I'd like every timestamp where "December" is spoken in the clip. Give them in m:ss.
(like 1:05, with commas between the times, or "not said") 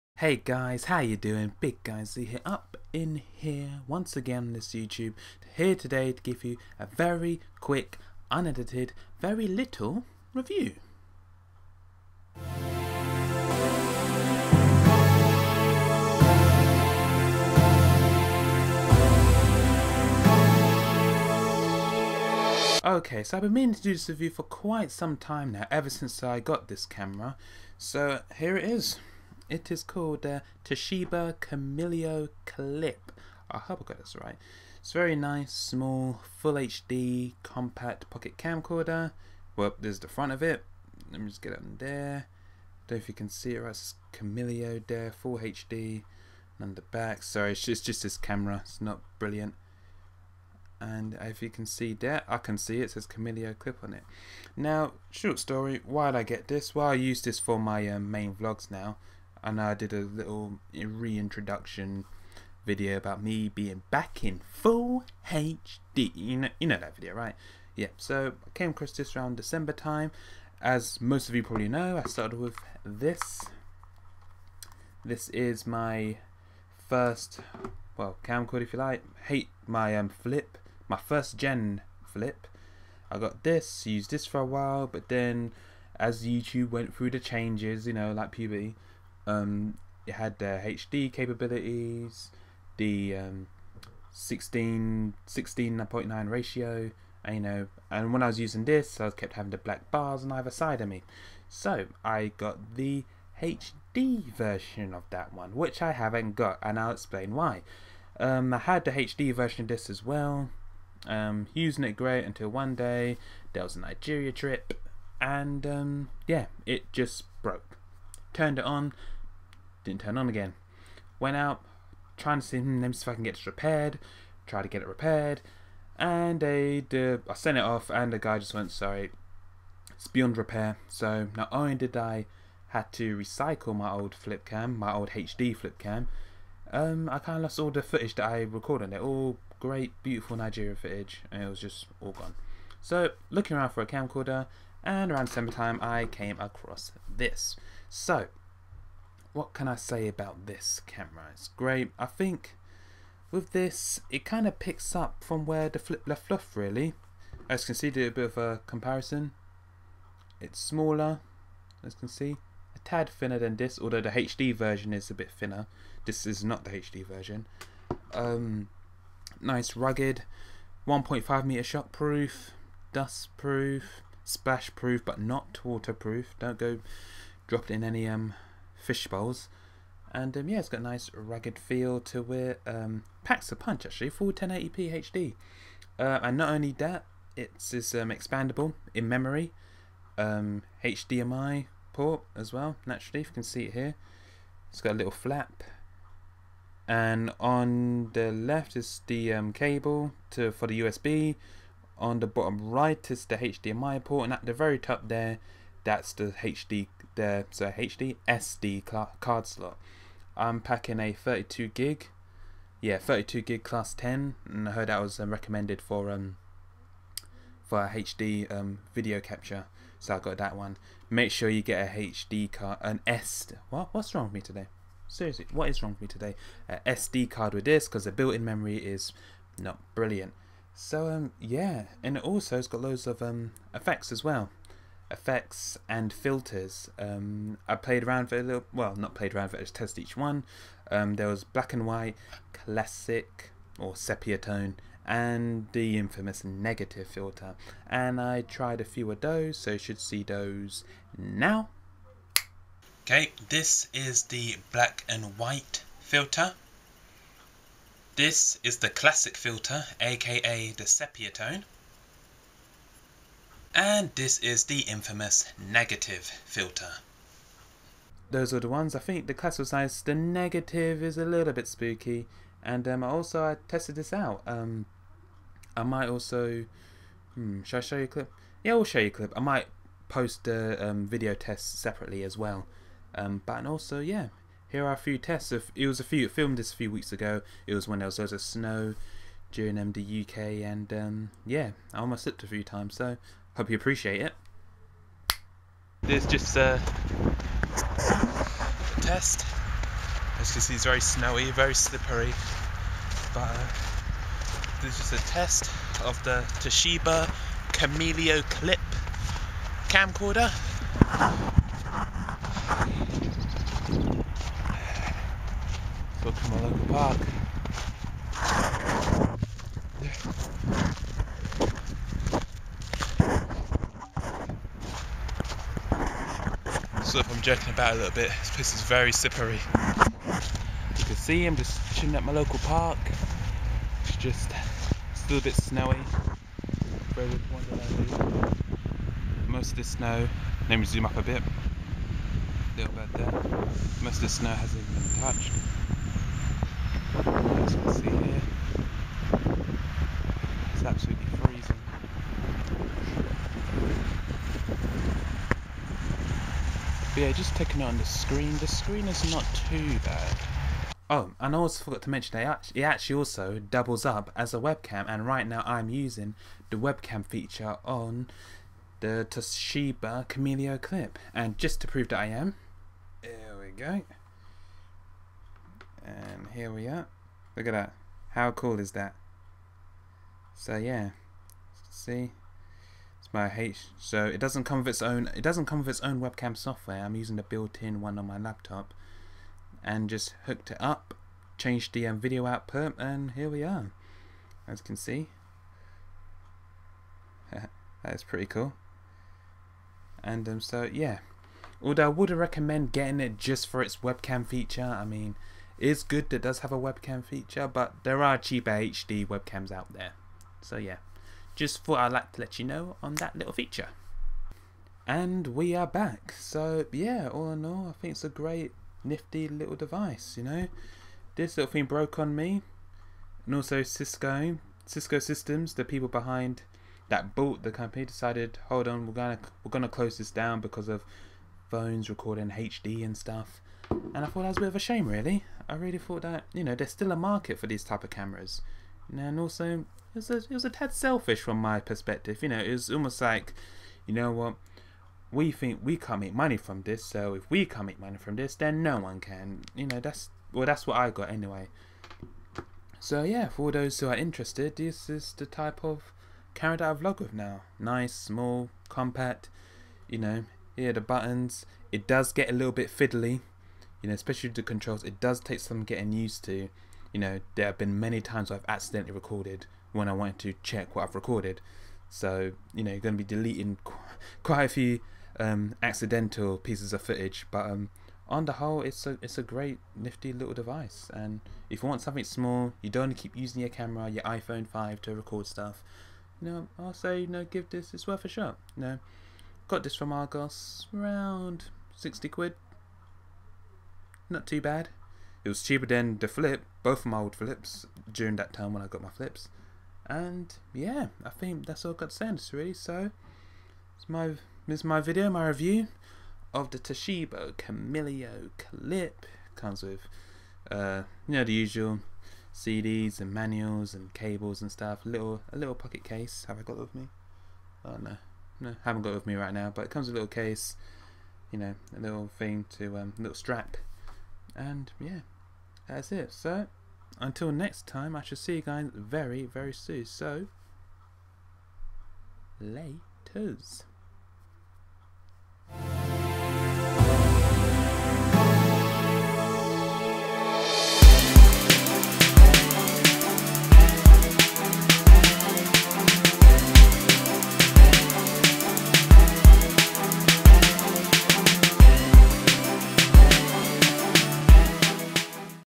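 1:09, 2:25.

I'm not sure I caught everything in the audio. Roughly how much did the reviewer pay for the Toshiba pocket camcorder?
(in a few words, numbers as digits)
60 quid.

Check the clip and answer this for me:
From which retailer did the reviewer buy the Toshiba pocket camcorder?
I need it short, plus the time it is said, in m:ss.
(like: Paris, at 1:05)
Argos, at 8:10.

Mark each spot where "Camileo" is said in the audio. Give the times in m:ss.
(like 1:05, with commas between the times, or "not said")
0:31, 0:44, 0:53, 5:07, 6:10, 8:27.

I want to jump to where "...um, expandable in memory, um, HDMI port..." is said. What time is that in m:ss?
3:07.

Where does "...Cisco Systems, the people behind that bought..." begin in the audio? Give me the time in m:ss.
7:04.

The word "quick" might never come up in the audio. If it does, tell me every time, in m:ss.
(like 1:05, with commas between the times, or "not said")
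0:07.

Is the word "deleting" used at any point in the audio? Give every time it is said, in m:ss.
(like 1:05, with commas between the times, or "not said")
7:53.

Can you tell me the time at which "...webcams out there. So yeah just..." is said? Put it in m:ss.
6:49.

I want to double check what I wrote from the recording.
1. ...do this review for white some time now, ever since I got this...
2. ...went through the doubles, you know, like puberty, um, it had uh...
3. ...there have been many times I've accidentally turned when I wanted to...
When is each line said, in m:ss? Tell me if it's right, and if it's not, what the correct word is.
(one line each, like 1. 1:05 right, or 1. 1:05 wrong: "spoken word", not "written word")
1. 0:23 wrong: "quite", not "white"
2. 1:26 wrong: "changes", not "doubles"
3. 7:47 wrong: "recorded", not "turned".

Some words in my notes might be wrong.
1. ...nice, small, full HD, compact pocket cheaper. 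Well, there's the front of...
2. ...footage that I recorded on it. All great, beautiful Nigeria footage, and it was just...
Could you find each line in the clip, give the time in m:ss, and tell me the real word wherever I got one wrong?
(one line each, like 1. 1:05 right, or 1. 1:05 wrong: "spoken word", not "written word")
1. 0:35 wrong: "camcorder", not "cheaper"
2. 2:17 right.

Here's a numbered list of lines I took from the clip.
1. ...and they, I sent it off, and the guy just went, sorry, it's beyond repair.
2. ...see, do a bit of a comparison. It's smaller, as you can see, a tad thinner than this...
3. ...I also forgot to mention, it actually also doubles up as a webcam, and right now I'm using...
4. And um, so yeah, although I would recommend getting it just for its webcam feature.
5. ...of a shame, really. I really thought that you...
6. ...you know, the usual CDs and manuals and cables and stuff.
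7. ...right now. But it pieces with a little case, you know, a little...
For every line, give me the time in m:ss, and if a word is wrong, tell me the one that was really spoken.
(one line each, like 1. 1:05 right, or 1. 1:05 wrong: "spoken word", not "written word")
1. 2:05 right
2. 2:37 right
3. 6:01 right
4. 6:40 right
5. 7:14 right
6. 8:31 right
7. 8:39 wrong: "comes", not "pieces".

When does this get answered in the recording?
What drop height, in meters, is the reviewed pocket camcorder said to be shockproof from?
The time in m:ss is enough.
2:50.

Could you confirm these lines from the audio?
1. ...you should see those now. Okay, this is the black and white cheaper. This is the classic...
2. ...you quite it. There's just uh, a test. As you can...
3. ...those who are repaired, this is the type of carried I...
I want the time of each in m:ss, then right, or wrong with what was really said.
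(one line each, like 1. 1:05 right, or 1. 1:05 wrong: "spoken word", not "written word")
1. 4:09 wrong: "filter", not "cheaper"
2. 4:53 wrong: "appreciate", not "quite"
3. 7:33 wrong: "interested", not "repaired".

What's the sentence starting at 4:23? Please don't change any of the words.
And this is the infamous negative filter.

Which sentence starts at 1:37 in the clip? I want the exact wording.
And when I was using this, I kept having the black bars on either side of me.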